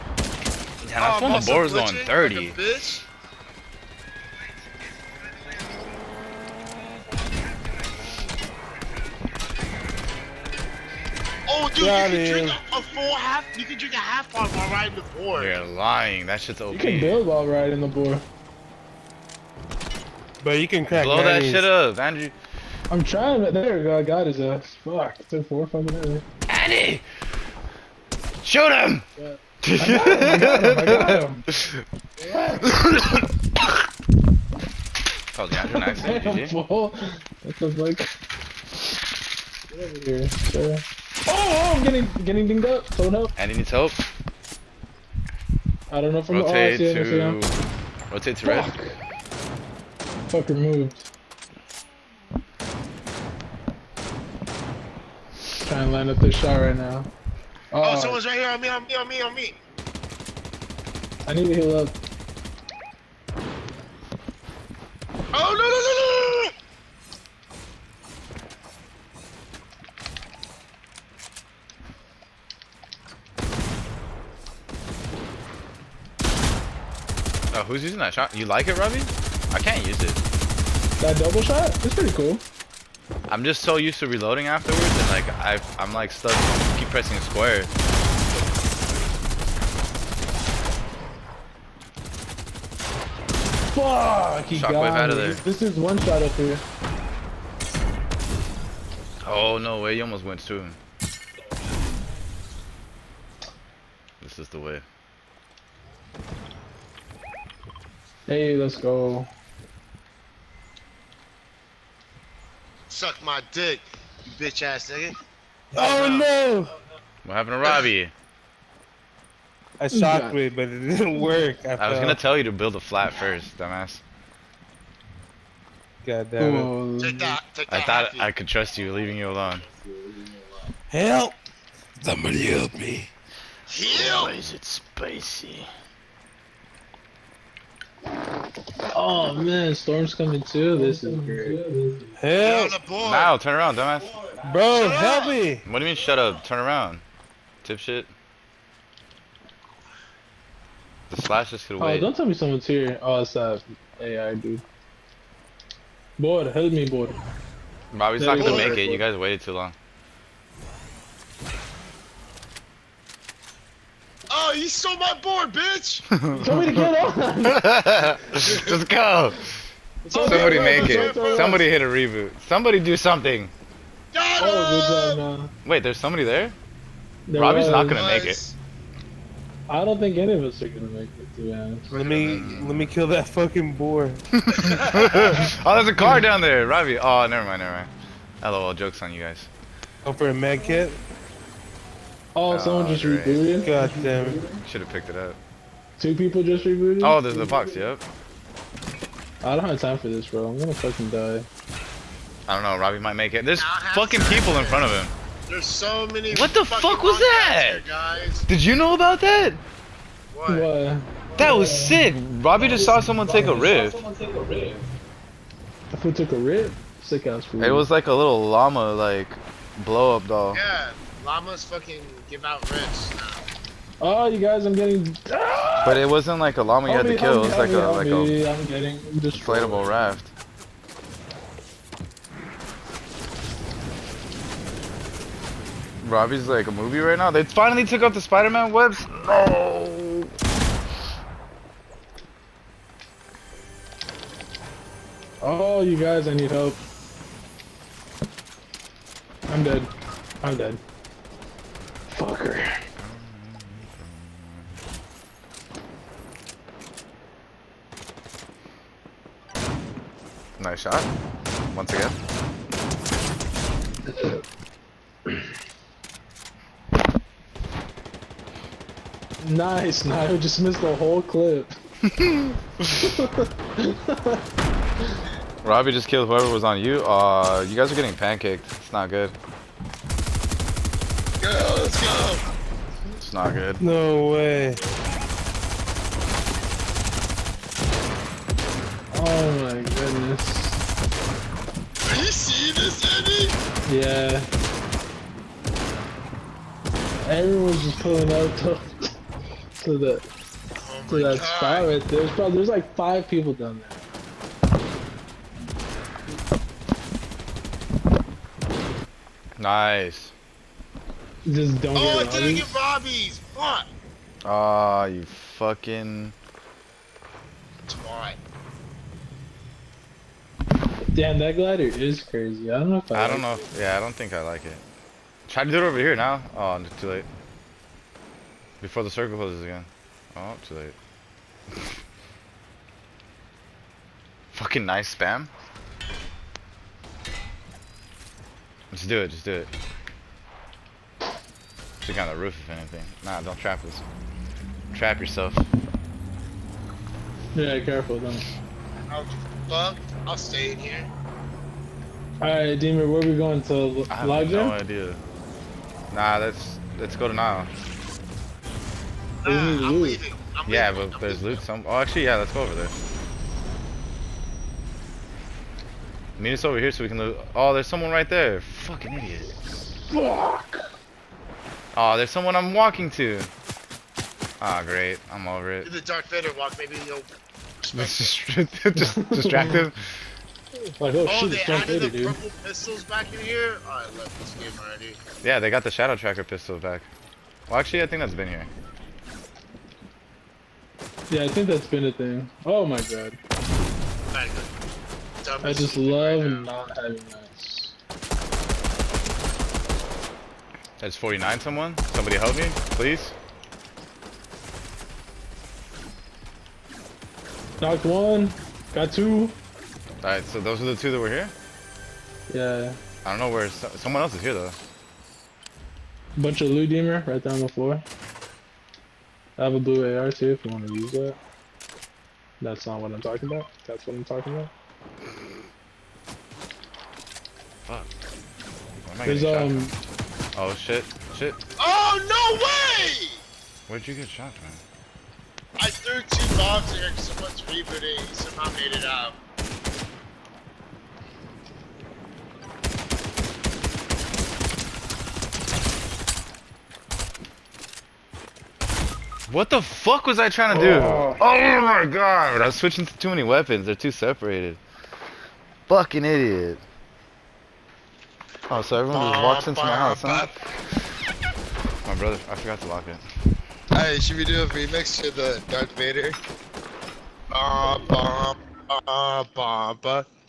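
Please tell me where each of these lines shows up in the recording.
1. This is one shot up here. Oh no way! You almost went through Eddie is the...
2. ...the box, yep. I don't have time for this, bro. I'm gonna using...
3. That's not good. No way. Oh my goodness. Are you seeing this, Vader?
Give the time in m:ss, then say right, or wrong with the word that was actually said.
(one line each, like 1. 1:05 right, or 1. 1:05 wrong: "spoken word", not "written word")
1. 1:35 wrong: "This", not "Eddie"
2. 3:17 wrong: "fucking", not "using"
3. 4:43 wrong: "Eddie", not "Vader".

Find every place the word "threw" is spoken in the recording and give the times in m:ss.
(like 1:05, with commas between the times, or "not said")
7:15.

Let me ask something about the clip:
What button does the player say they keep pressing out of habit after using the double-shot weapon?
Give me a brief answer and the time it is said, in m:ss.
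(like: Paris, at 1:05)
square, at 1:27.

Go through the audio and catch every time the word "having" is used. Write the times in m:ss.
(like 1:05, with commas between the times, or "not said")
6:36.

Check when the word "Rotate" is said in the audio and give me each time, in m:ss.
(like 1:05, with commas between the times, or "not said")
0:48.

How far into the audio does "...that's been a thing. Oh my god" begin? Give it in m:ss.
6:31.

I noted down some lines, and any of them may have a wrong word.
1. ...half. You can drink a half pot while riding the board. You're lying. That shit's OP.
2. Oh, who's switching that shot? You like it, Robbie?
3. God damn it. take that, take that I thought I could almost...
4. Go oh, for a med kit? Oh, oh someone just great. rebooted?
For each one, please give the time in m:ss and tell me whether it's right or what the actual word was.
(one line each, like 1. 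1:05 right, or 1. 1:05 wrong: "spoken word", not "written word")
1. 0:13 right
2. 1:17 wrong: "using", not "switching"
3. 2:06 wrong: "trust", not "almost"
4. 3:10 right.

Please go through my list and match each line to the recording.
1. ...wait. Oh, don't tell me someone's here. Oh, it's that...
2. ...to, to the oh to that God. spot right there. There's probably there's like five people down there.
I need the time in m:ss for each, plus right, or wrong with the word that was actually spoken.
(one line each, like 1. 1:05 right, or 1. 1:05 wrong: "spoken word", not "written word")
1. 2:31 right
2. 4:58 right.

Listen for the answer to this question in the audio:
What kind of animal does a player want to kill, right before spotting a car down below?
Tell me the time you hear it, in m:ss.
3:03.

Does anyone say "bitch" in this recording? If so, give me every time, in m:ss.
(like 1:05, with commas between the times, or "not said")
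1:54, 2:45.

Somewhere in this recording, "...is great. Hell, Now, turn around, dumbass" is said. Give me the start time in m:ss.
2:21.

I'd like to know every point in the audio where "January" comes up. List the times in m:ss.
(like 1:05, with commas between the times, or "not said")
not said.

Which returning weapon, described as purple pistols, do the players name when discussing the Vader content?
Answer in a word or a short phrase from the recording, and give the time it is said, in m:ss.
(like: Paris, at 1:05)
Shadow Tracker pistol, at 6:25.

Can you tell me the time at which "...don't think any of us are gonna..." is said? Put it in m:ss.
2:59.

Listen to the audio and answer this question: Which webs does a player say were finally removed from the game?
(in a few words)
Spider-Man webs.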